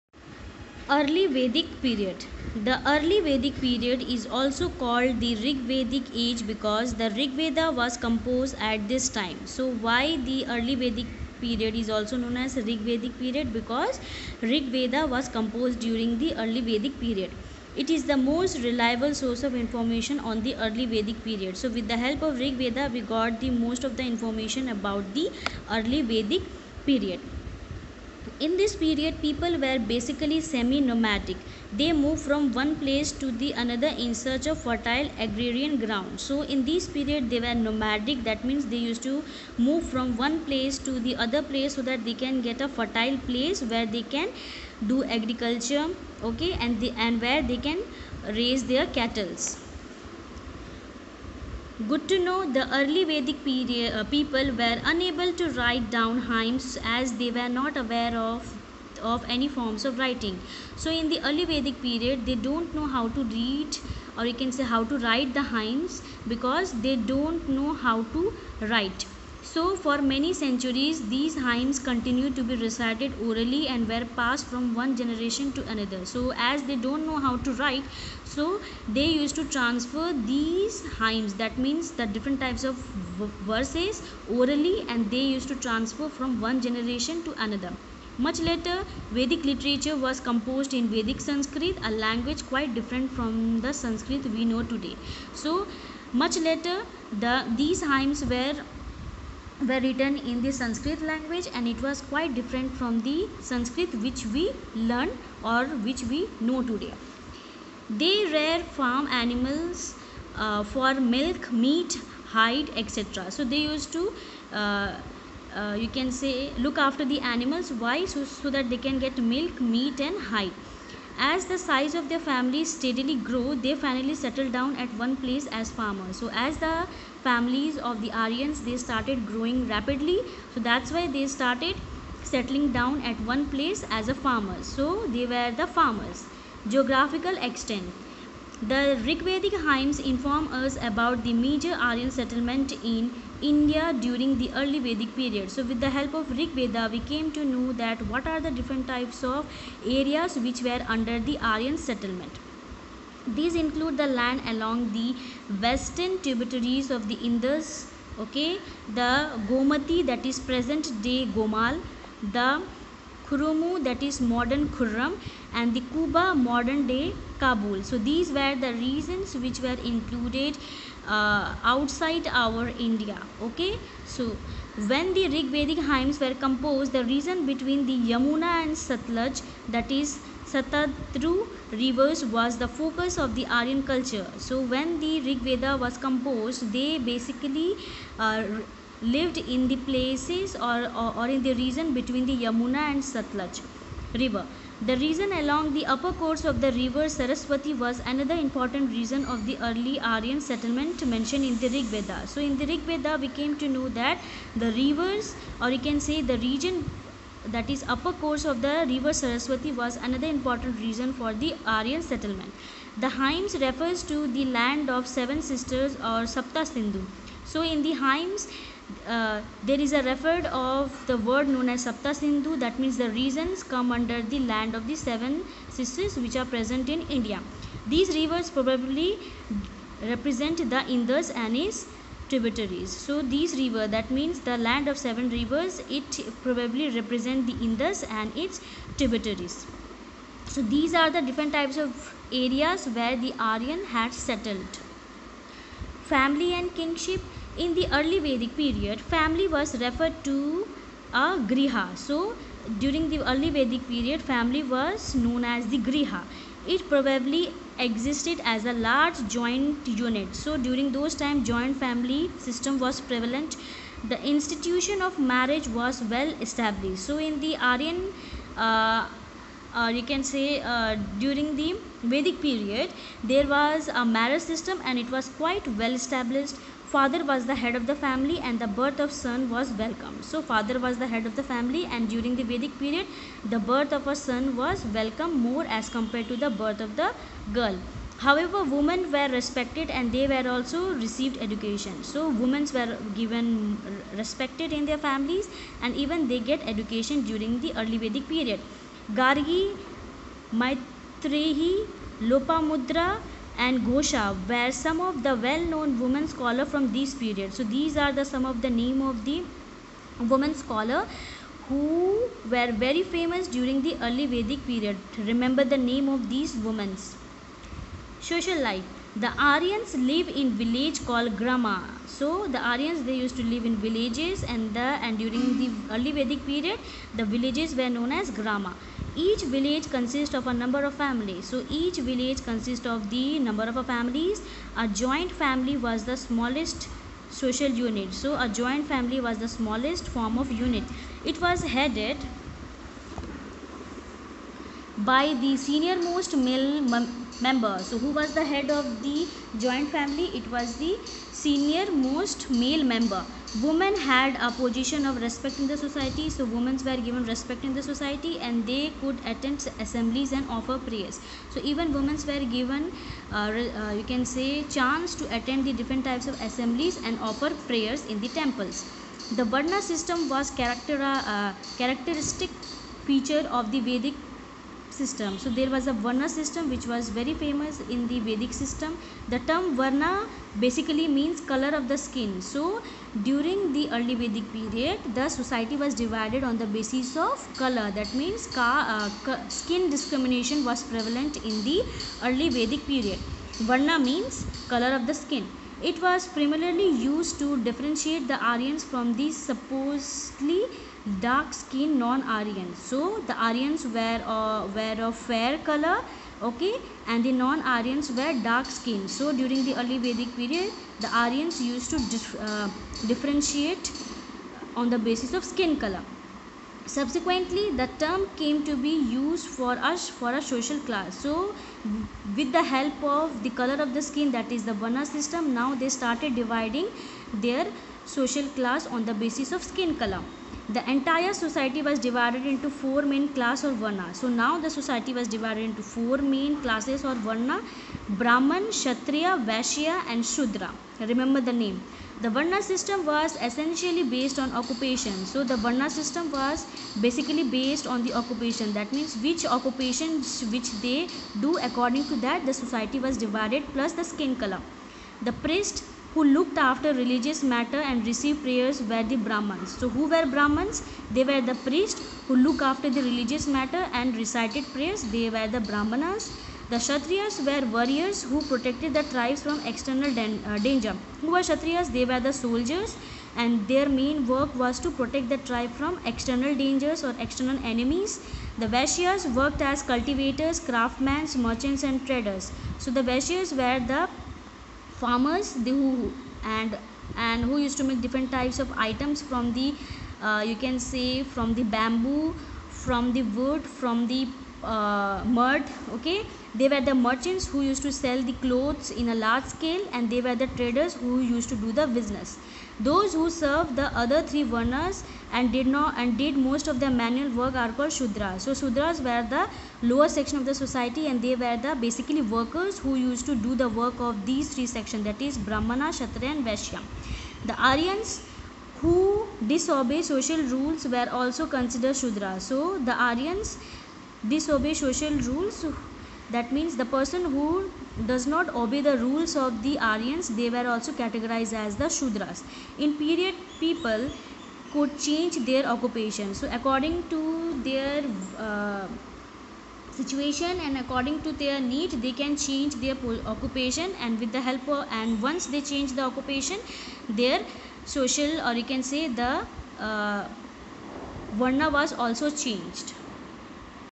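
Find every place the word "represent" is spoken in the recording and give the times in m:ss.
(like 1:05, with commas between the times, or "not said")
3:50, 3:56.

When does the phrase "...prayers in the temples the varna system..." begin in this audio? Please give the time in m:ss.
6:07.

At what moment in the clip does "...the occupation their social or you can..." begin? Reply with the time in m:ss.
9:05.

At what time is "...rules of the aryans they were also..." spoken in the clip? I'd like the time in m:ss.
8:48.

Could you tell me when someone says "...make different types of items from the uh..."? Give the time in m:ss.
8:07.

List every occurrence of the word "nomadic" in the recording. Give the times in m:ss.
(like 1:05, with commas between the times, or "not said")
0:30, 0:37.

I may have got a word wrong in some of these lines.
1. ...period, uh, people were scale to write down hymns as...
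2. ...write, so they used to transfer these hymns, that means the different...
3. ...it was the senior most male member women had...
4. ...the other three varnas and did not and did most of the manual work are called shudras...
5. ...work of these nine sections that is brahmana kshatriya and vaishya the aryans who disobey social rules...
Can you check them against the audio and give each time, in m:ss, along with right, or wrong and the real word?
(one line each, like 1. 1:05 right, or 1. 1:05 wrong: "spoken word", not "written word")
1. 0:53 wrong: "unable", not "scale"
2. 1:17 right
3. 5:50 right
4. 8:23 right
5. 8:33 wrong: "three", not "nine".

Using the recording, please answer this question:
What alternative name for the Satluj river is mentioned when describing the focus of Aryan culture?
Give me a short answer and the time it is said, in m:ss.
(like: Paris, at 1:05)
Satadru, at 3:00.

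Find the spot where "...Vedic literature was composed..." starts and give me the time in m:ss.
1:29.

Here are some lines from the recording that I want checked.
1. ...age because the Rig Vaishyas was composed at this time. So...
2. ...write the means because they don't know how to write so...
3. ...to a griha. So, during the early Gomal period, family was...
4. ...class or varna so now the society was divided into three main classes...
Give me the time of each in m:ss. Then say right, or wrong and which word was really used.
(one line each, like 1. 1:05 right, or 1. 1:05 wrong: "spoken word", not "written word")
1. 0:06 wrong: "Veda", not "Vaishyas"
2. 1:04 wrong: "hymns", not "means"
3. 4:10 wrong: "Vedic", not "Gomal"
4. 7:13 wrong: "four", not "three".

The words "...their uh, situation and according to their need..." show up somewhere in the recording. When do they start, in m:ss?
8:57.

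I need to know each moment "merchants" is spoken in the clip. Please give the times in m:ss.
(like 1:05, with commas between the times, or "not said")
8:01, 8:16.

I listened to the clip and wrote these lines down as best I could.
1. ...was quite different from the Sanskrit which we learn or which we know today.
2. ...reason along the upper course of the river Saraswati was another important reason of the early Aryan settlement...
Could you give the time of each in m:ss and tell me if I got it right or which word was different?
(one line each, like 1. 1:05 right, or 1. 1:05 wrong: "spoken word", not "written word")
1. 1:41 right
2. 3:14 wrong: "region", not "reason".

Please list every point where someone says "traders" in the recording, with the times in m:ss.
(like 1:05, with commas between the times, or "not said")
8:02, 8:20.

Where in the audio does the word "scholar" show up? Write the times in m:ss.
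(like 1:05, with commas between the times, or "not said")
5:06, 5:10.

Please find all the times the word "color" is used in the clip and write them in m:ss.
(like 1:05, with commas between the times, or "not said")
6:21, 6:27, 6:34, 6:45, 6:55, 7:03, 7:09, 7:34.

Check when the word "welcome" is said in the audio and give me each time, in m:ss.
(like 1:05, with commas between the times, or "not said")
4:39, 4:44.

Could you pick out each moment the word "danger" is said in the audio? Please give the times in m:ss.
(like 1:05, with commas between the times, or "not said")
7:50, 7:56.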